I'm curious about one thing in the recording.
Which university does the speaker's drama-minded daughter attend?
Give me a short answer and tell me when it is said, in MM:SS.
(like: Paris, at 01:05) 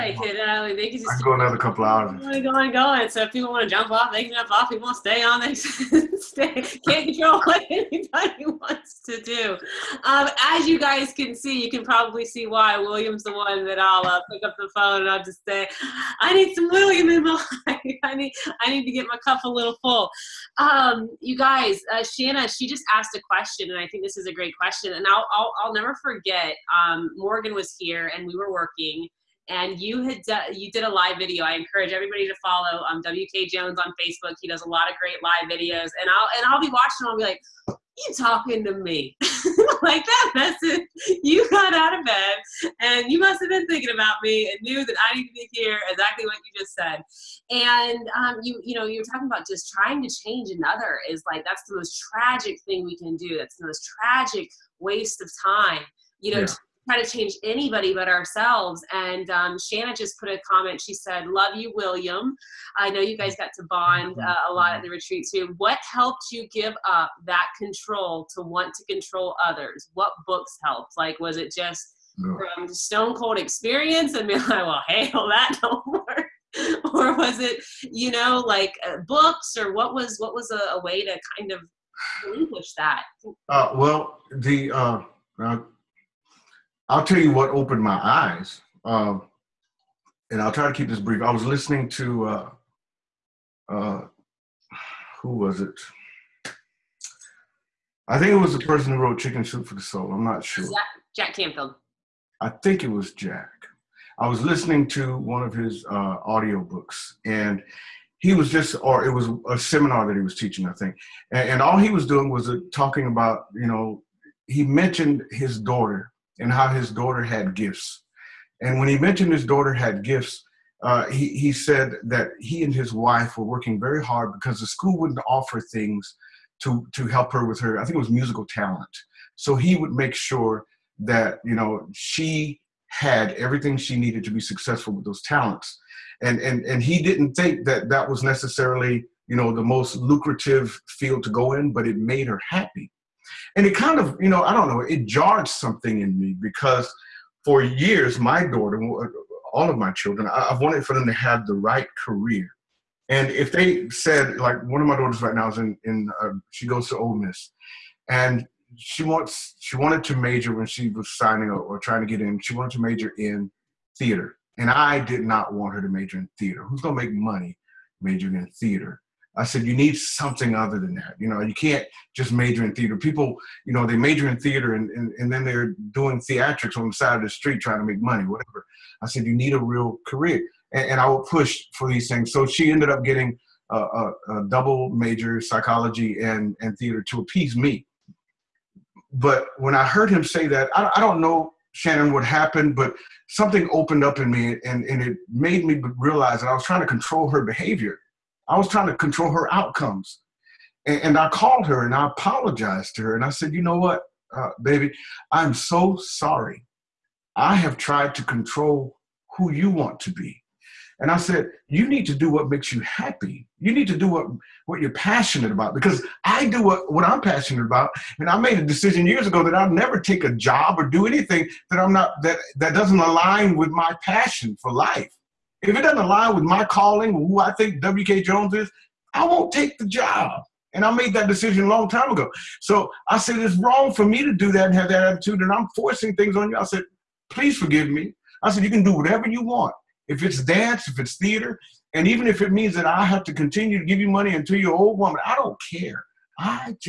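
Ole Miss, at 02:36.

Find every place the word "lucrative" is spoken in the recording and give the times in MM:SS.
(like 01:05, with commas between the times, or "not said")
02:19.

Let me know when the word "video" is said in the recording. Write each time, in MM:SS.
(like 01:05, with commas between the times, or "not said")
00:31, 00:35.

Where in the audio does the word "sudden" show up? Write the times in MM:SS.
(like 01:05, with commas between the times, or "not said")
not said.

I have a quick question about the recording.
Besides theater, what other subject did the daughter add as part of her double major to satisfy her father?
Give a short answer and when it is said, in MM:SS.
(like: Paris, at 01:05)
Psychology, at 03:05.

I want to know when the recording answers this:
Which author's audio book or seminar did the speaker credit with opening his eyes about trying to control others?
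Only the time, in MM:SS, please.
01:41.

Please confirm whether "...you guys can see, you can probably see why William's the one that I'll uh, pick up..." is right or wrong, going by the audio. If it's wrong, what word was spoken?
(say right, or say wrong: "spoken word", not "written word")
right.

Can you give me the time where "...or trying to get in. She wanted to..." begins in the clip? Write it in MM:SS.
02:41.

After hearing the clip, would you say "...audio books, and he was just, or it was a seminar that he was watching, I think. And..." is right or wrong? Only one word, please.
wrong.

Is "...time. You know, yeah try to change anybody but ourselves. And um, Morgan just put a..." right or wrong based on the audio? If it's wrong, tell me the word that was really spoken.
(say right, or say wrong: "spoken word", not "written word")
wrong: "Shanna", not "Morgan".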